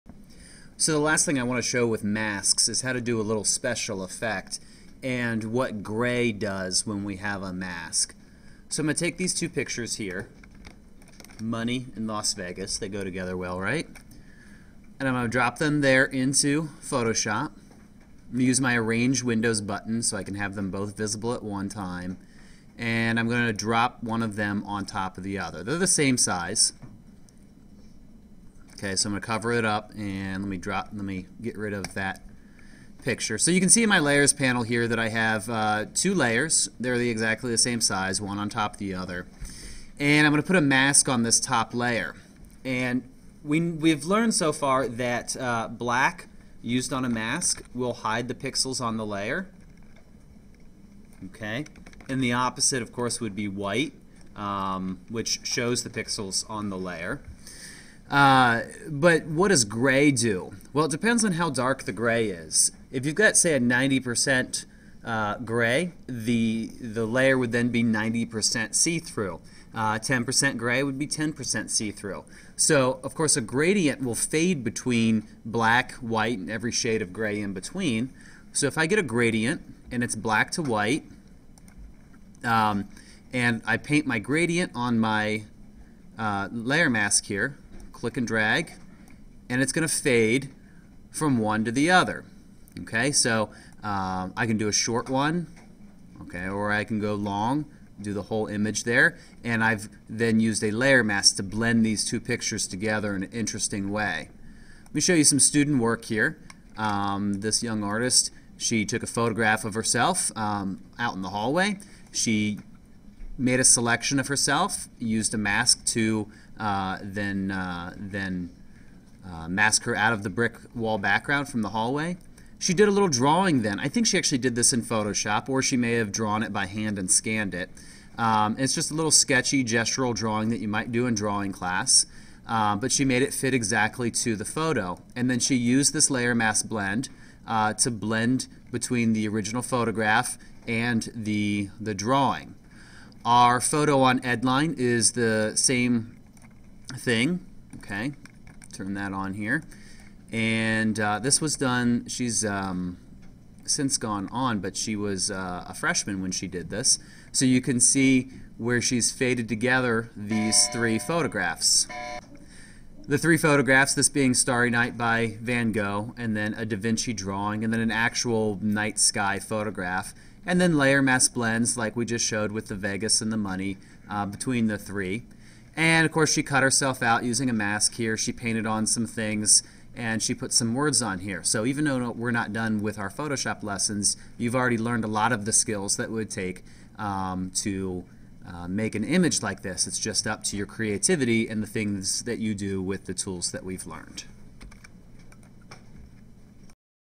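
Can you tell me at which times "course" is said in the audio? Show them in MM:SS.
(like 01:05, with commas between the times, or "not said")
00:52, 01:13, 02:56.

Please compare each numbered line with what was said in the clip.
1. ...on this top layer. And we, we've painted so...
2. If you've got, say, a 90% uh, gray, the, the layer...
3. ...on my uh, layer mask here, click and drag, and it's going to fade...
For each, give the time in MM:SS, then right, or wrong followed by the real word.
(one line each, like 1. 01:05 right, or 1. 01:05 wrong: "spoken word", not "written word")
1. 00:41 wrong: "learned", not "painted"
2. 01:02 right
3. 01:24 right.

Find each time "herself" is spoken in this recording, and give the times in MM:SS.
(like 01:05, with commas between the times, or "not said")
01:49, 01:54, 02:56.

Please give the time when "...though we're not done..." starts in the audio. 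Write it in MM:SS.
03:01.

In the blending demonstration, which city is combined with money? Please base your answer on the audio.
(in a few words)
Las Vegas.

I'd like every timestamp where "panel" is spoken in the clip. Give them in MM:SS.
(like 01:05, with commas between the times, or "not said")
00:34.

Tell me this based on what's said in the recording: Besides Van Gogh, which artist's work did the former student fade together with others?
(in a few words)
Da Vinci.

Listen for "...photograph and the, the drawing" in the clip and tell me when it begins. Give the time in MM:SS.
02:19.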